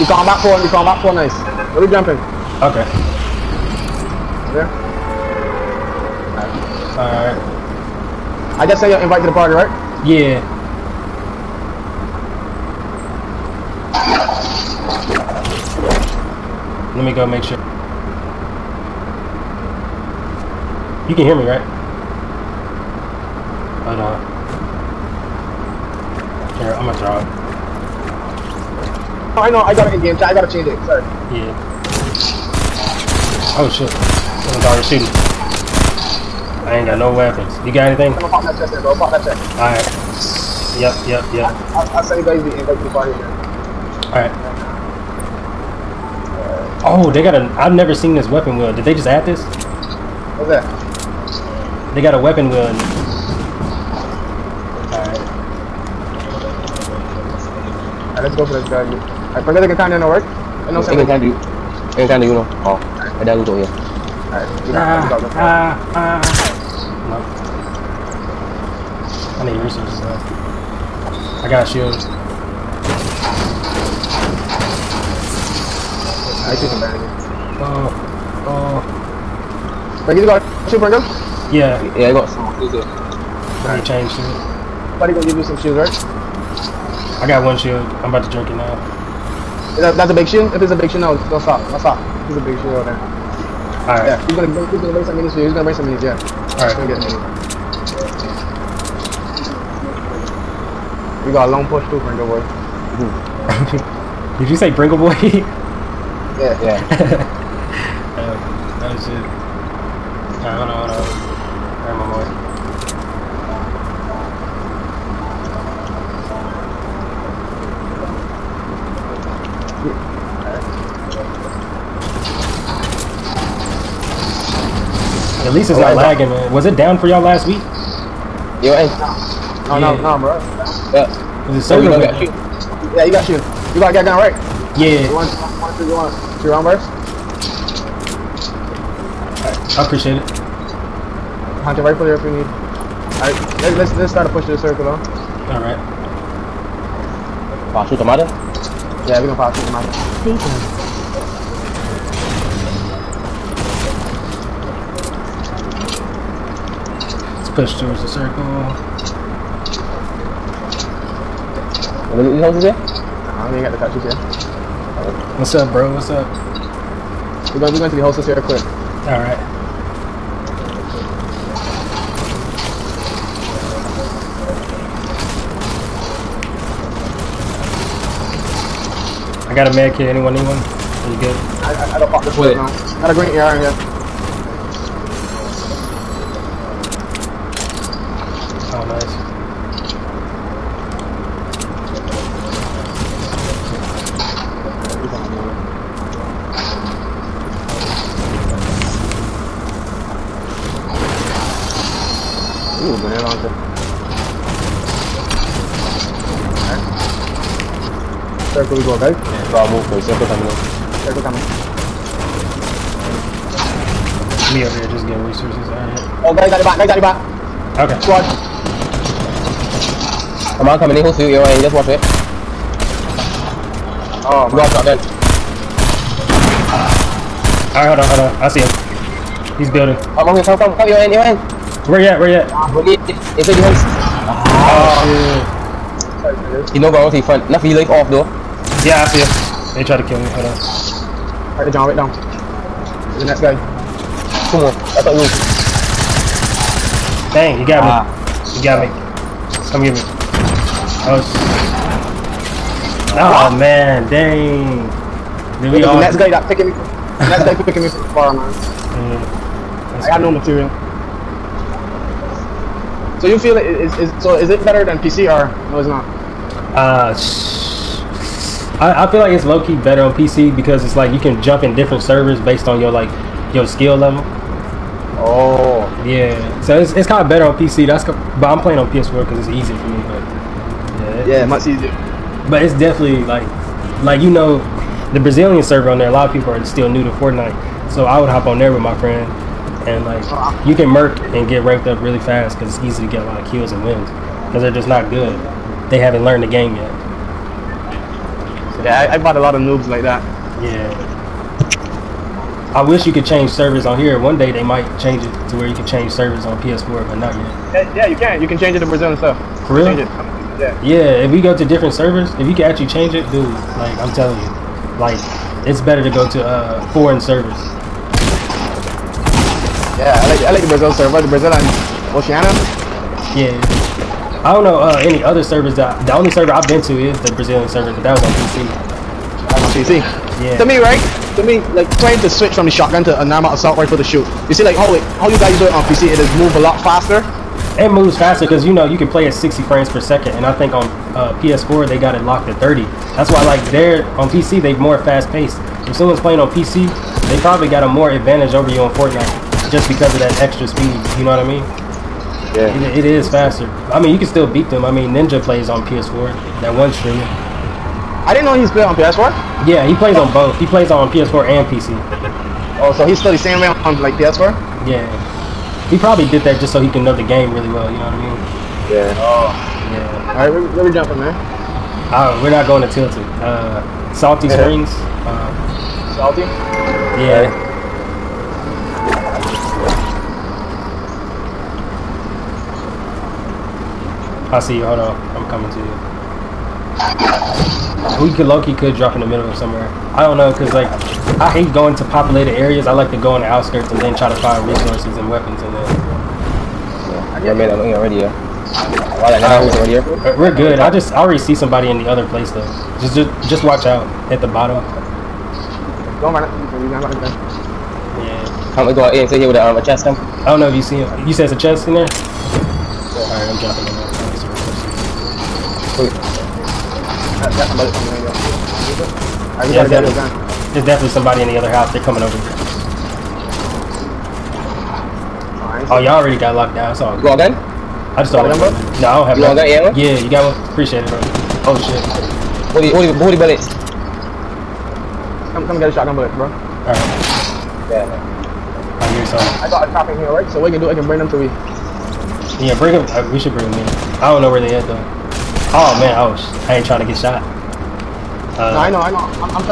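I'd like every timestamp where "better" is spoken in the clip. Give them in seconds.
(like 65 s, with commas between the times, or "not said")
264 s, 269 s, 277 s, 315 s.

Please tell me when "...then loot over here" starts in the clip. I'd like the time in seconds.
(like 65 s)
63 s.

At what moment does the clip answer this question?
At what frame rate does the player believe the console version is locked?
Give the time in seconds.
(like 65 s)
342 s.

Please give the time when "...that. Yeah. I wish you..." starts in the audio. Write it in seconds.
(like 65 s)
300 s.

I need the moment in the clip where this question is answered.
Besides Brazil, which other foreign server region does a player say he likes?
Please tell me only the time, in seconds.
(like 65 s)
322 s.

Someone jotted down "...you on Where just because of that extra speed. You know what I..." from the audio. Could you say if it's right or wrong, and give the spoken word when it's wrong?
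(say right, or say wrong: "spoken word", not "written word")
wrong: "Fortnite", not "Where".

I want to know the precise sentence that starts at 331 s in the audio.
To me, like trying to switch from the shotgun to a normal assault rifle to shoot.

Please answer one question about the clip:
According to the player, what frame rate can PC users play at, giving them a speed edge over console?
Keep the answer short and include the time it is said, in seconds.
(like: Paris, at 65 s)
60 frames per second, at 339 s.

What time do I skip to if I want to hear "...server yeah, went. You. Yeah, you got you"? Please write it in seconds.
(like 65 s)
131 s.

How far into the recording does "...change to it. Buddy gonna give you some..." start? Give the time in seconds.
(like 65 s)
83 s.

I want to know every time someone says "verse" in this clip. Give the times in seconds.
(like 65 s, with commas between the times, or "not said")
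136 s.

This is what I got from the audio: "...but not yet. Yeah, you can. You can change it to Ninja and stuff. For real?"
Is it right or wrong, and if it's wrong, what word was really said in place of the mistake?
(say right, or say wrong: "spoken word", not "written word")
wrong: "Brazil", not "Ninja".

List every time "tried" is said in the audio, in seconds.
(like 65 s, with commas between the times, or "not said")
239 s.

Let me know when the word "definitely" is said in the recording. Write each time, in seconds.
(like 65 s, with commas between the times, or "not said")
282 s, 420 s.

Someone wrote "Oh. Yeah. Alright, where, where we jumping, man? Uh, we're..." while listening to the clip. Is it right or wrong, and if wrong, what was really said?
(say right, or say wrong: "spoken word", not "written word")
right.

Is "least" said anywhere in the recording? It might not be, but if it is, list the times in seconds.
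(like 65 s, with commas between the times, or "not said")
125 s.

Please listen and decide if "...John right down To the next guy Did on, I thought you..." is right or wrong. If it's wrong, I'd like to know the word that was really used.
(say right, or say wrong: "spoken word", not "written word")
wrong: "Come", not "Did".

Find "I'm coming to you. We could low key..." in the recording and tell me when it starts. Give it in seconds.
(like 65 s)
385 s.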